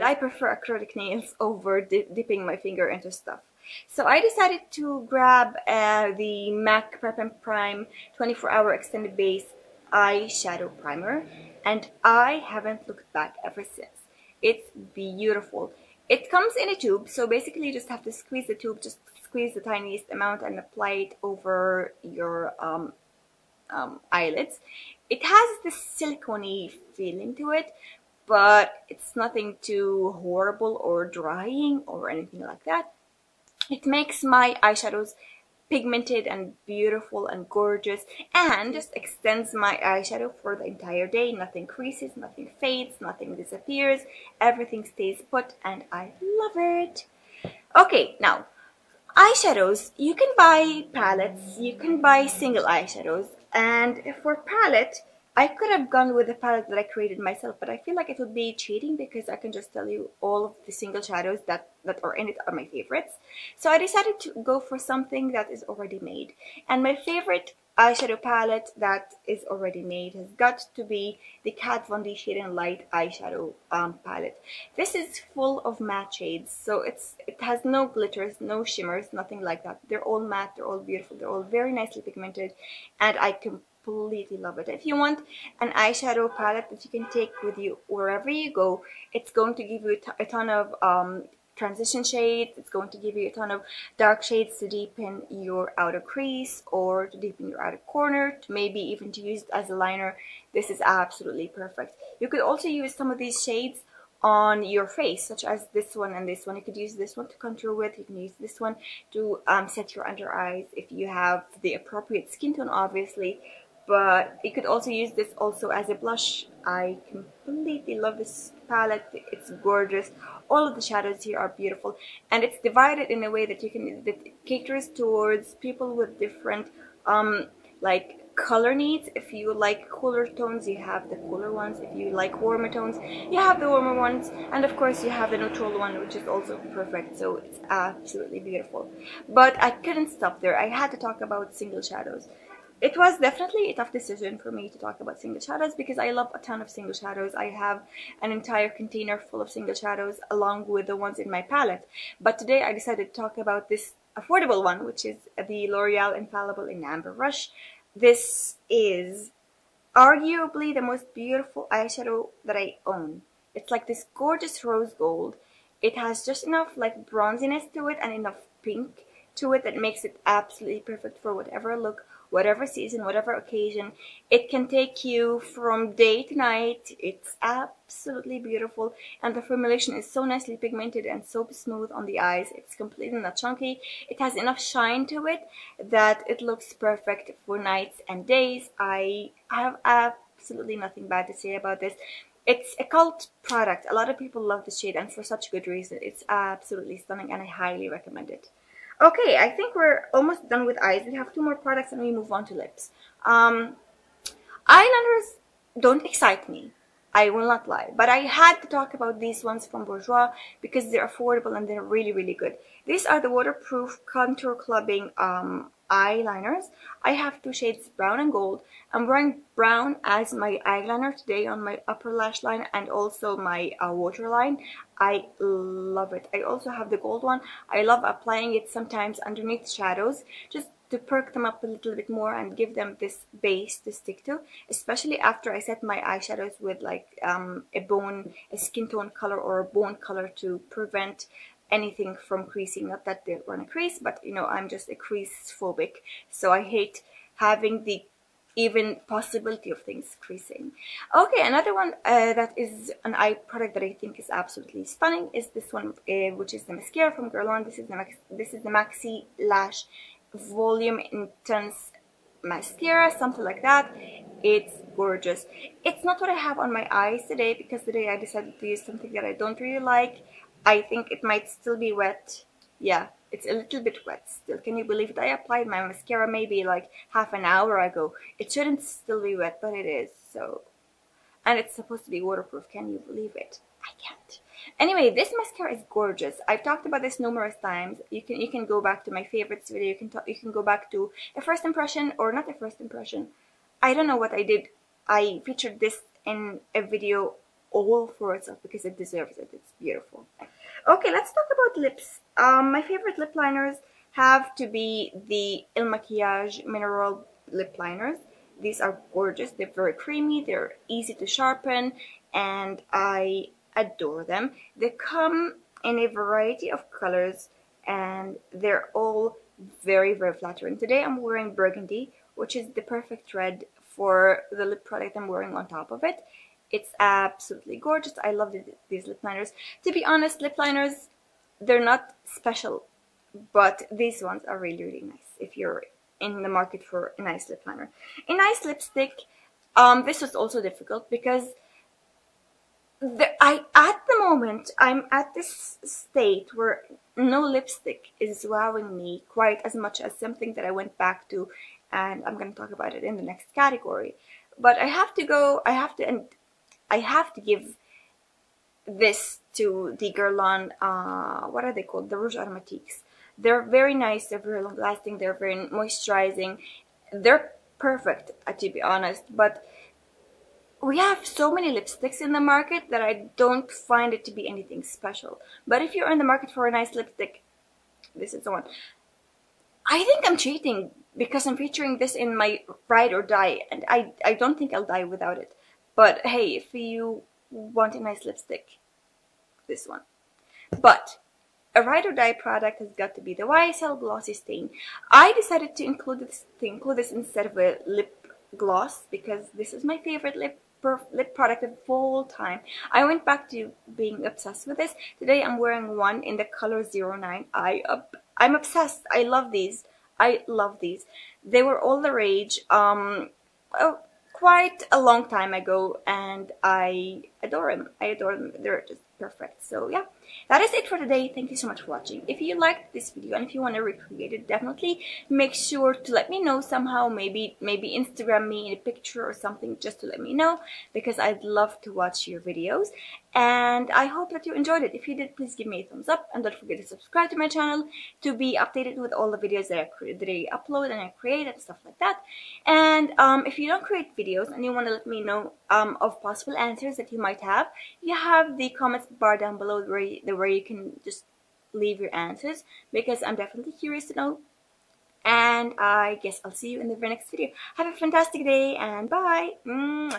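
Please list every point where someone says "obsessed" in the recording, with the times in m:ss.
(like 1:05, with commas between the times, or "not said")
6:44, 6:48.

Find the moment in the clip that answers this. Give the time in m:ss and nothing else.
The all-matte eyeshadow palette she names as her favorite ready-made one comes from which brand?
1:11.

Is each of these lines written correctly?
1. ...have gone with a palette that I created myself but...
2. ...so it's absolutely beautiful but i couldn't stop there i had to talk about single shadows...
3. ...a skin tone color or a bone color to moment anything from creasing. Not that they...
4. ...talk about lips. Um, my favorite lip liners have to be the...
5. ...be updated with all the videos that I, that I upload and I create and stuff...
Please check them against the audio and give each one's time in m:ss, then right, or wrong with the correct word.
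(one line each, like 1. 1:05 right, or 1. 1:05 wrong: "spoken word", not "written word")
1. 0:55 right
2. 2:17 right
3. 3:58 wrong: "prevent", not "moment"
4. 5:01 right
5. 7:18 right.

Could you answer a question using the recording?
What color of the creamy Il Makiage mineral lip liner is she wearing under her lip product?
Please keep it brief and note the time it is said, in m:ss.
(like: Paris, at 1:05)
Burgundy, at 5:21.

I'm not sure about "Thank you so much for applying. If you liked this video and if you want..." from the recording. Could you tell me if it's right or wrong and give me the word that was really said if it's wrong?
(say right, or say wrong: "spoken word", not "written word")
wrong: "watching", not "applying".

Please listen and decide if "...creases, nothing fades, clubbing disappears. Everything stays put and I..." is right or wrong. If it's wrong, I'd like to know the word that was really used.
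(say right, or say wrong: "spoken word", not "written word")
wrong: "nothing", not "clubbing".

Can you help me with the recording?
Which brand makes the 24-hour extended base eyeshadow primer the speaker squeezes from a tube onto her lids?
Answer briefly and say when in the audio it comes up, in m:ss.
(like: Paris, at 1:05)
MAC, at 0:06.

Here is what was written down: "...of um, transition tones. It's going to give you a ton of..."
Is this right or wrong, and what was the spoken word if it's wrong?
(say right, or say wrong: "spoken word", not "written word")
wrong: "shades", not "tones".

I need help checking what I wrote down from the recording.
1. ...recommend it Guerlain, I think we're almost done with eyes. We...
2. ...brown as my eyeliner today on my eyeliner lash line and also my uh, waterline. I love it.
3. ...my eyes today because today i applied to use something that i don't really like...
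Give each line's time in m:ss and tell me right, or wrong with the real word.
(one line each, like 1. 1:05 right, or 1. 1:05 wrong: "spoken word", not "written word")
1. 3:17 wrong: "Okay", not "Guerlain"
2. 3:39 wrong: "upper", not "eyeliner"
3. 4:26 wrong: "decided", not "applied".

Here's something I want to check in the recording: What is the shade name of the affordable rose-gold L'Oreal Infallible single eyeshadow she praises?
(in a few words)
Amber Rush.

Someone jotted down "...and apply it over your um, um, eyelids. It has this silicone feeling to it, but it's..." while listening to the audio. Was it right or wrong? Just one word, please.
right.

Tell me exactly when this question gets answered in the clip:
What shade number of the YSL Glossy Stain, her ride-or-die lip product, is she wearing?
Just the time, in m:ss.
6:46.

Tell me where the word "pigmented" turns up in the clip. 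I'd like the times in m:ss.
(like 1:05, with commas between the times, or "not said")
0:35, 1:22, 3:00.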